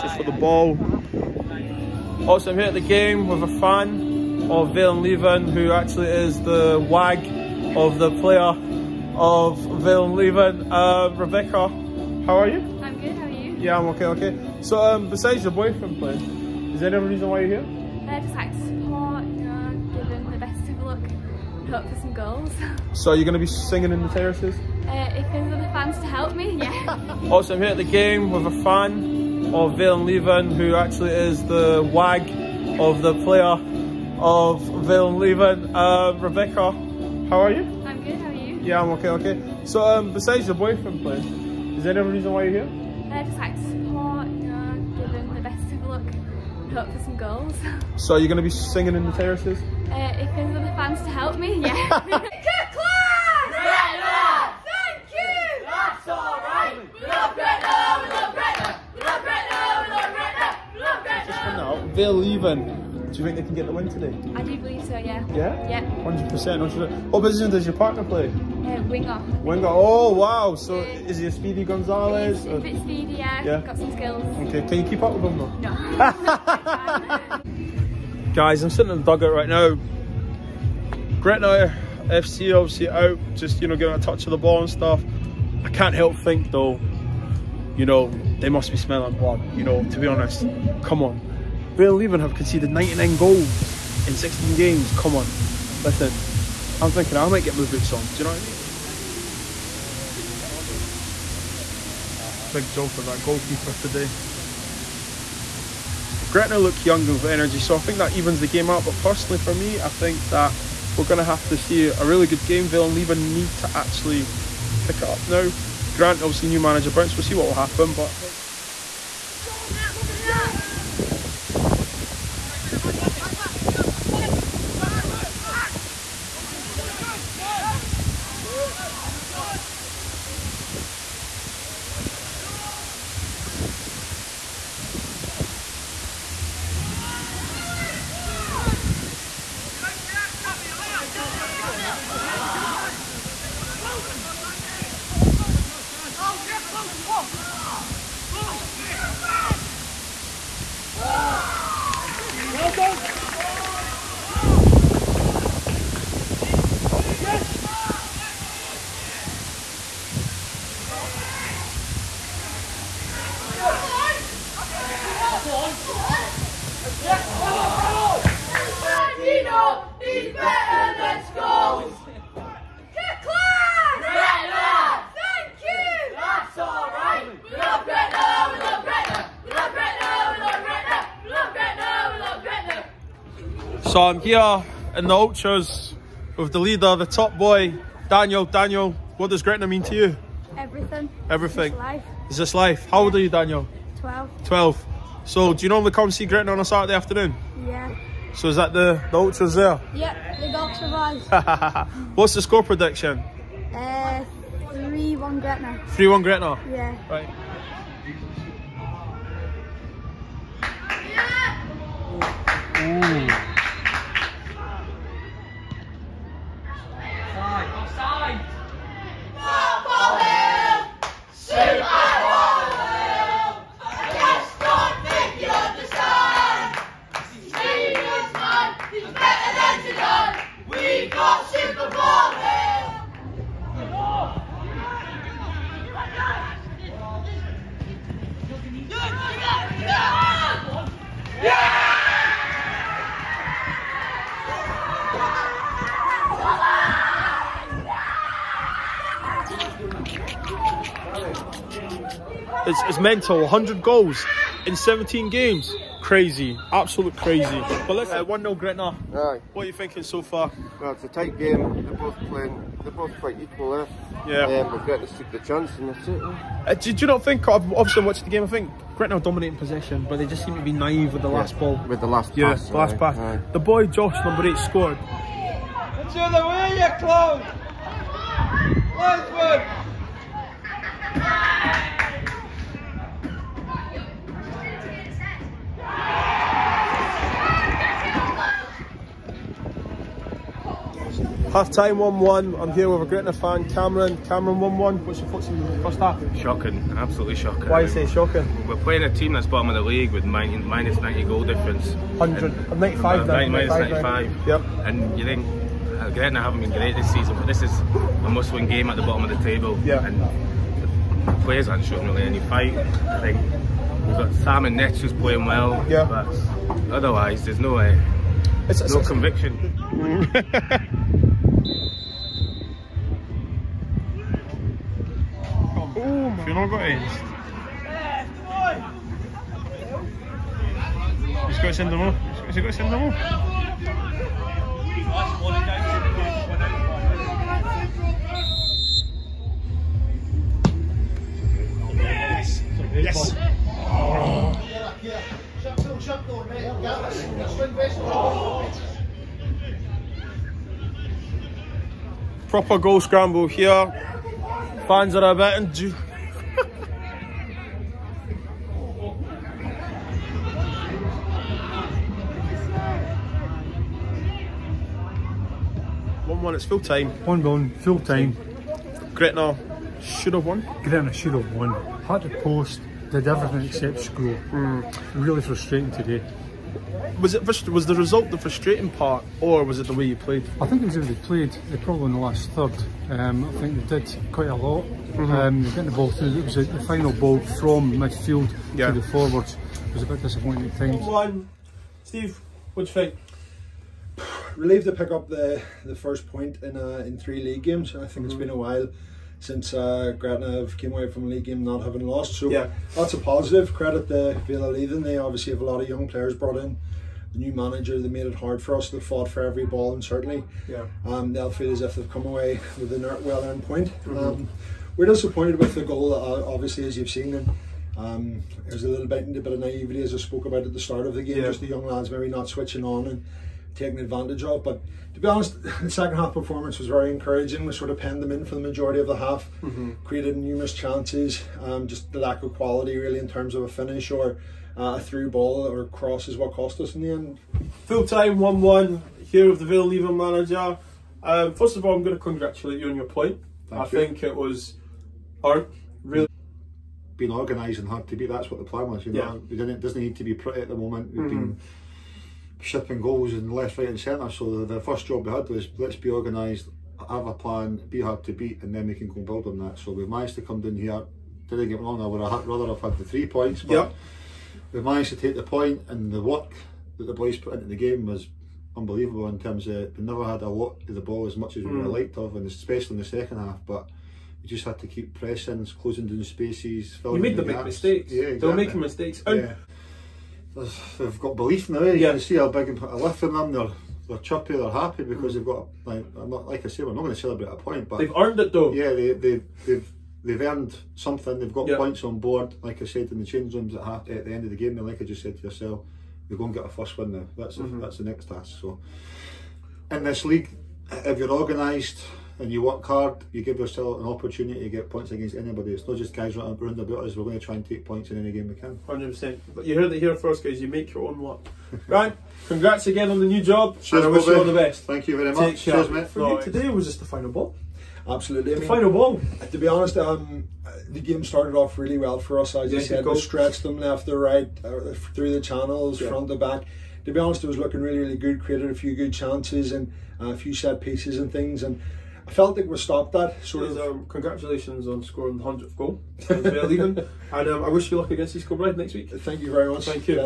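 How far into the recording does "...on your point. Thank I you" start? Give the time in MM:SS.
07:22.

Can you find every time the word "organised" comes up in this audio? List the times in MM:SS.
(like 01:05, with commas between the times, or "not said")
07:27, 07:36, 08:21.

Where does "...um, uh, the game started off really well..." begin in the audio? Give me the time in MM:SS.
08:39.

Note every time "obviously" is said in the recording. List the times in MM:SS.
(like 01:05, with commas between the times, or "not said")
01:22, 01:56, 04:27, 06:45, 06:56.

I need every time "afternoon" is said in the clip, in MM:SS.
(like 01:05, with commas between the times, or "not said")
03:16.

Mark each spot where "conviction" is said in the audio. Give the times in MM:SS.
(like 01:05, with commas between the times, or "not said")
05:19.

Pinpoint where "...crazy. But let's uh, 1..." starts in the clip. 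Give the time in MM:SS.
04:17.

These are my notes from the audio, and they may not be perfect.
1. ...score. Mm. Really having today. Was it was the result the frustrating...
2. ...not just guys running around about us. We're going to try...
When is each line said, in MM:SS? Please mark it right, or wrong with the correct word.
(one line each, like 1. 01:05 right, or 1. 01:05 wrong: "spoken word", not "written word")
1. 06:14 wrong: "frustrating", not "having"
2. 08:25 right.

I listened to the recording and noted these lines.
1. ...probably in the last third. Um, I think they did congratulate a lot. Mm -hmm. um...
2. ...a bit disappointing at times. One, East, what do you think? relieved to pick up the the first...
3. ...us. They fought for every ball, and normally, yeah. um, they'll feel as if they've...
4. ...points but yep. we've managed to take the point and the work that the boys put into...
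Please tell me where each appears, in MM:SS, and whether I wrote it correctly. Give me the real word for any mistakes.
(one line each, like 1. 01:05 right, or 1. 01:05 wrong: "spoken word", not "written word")
1. 06:21 wrong: "quite", not "congratulate"
2. 06:30 wrong: "Steve", not "East"
3. 06:48 wrong: "certainly", not "normally"
4. 07:43 right.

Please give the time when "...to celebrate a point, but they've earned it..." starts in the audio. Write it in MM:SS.
08:07.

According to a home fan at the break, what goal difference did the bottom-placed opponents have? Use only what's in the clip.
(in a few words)
Minus 95.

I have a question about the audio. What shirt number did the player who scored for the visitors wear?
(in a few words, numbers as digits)
8.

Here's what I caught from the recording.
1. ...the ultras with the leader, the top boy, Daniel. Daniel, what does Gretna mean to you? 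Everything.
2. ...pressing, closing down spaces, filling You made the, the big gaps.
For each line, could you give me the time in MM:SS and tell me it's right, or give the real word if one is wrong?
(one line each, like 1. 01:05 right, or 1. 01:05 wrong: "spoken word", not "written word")
1. 03:05 right
2. 07:55 right.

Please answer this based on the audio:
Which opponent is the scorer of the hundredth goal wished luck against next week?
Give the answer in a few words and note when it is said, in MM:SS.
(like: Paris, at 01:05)
East Kilbride, at 08:58.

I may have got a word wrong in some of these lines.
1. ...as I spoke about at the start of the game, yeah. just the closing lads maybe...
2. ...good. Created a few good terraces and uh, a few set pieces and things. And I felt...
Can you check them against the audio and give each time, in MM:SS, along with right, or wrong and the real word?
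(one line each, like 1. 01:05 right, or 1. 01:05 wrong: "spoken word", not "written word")
1. 07:00 wrong: "young", not "closing"
2. 08:48 wrong: "chances", not "terraces".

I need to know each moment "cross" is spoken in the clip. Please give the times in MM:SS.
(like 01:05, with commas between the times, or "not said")
07:15.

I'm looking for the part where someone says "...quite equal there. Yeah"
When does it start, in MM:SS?
04:23.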